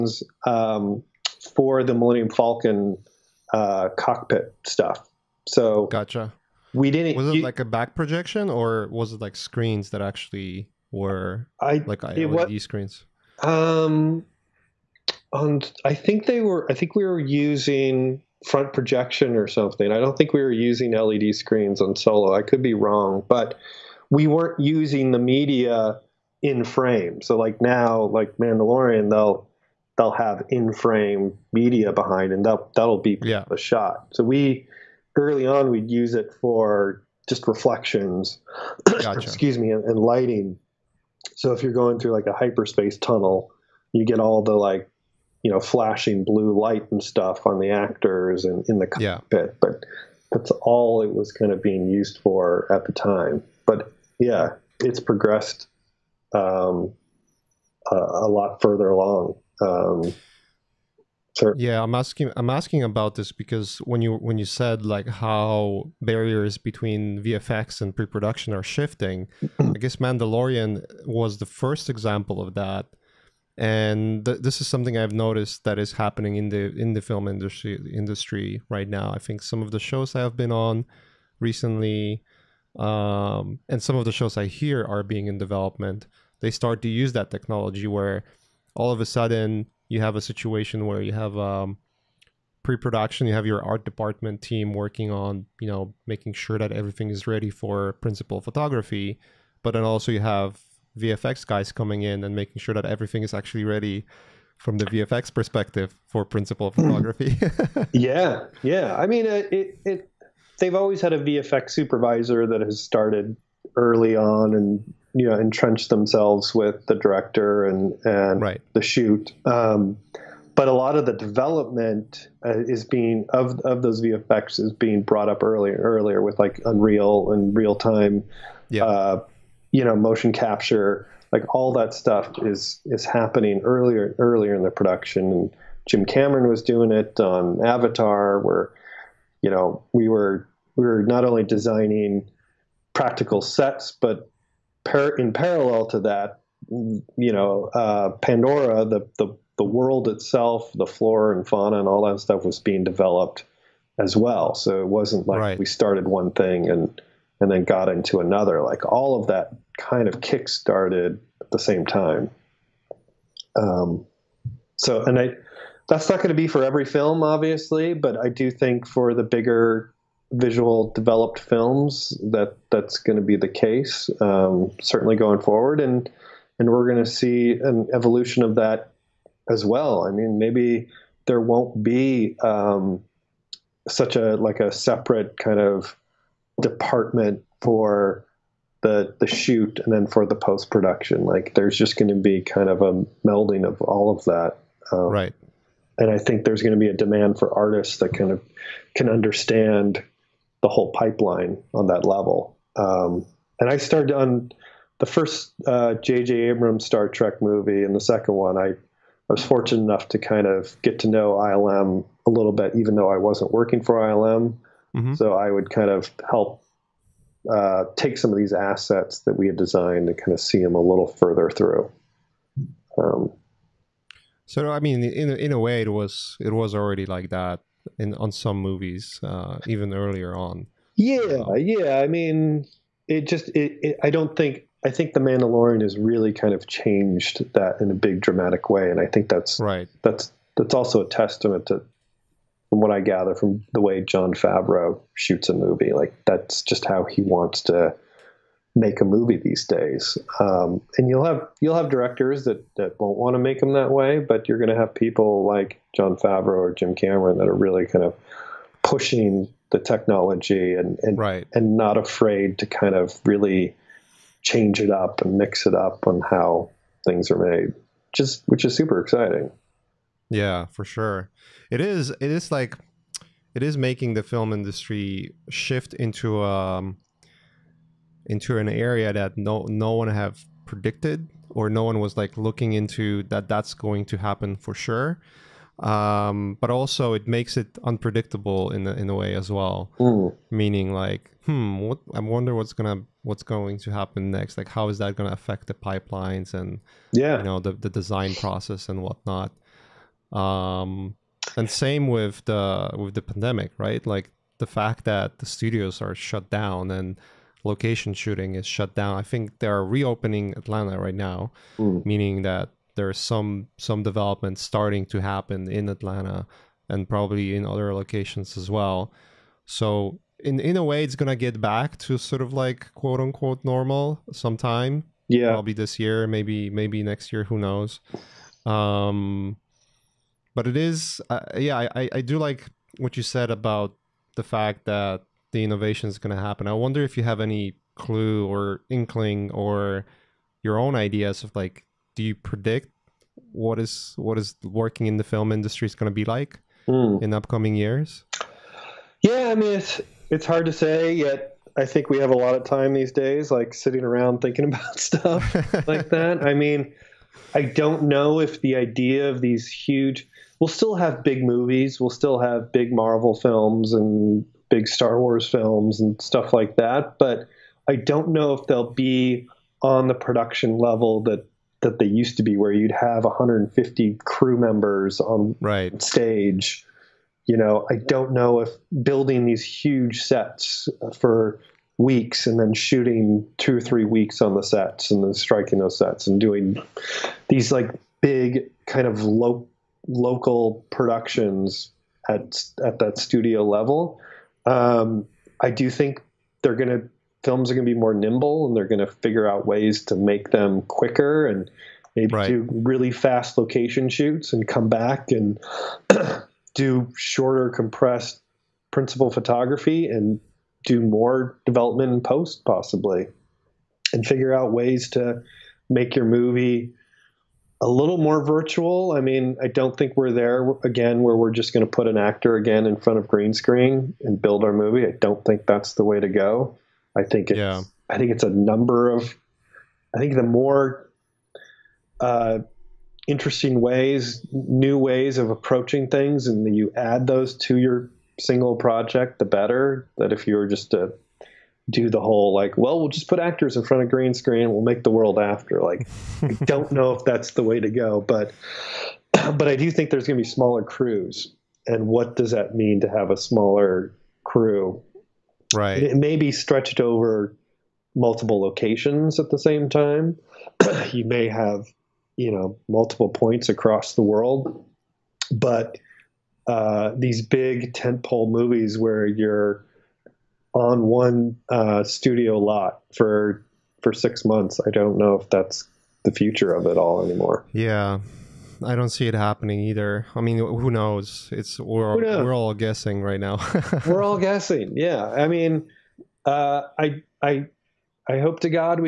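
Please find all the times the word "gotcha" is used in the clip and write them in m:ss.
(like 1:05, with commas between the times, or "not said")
0:05, 0:38.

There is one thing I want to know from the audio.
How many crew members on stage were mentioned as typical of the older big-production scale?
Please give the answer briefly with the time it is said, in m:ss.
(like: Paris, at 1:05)
150, at 6:13.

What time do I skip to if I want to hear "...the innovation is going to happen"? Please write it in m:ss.
5:35.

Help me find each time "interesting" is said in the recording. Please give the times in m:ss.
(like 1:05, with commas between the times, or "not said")
7:13.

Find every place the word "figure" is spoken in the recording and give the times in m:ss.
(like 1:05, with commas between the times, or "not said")
6:39, 6:54.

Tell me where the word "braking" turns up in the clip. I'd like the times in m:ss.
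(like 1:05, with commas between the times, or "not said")
not said.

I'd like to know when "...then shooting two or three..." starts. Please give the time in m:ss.
6:22.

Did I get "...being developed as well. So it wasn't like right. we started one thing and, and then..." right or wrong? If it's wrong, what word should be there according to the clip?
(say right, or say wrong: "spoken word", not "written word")
right.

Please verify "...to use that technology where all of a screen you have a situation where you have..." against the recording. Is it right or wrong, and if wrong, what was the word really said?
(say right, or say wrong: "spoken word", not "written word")
wrong: "sudden", not "screen".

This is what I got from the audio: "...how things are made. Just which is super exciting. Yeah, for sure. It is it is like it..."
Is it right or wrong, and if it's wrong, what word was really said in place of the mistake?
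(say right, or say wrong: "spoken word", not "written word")
right.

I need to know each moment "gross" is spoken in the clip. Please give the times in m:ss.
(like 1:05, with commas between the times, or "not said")
not said.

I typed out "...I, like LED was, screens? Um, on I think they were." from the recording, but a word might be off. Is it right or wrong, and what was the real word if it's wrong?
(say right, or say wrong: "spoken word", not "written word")
right.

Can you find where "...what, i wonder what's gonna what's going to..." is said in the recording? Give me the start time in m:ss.
4:51.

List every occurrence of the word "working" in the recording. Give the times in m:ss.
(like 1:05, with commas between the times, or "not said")
1:34, 3:33, 5:44.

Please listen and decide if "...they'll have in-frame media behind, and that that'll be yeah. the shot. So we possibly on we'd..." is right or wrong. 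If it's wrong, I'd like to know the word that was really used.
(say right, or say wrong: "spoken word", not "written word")
wrong: "early", not "possibly".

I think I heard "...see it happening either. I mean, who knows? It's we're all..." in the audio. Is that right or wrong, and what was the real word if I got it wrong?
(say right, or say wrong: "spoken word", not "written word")
right.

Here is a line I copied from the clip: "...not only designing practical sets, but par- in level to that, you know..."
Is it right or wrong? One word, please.
wrong.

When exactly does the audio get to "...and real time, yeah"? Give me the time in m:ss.
2:07.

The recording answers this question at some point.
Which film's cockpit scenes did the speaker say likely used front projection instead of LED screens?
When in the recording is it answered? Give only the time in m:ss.
0:21.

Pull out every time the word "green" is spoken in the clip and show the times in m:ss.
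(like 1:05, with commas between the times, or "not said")
7:03, 7:24.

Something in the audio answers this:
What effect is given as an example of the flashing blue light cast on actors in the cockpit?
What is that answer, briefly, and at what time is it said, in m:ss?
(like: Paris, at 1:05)
hyperspace tunnel, at 0:42.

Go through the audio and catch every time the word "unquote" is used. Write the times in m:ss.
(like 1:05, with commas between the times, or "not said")
5:23.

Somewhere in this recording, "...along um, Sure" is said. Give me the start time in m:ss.
0:58.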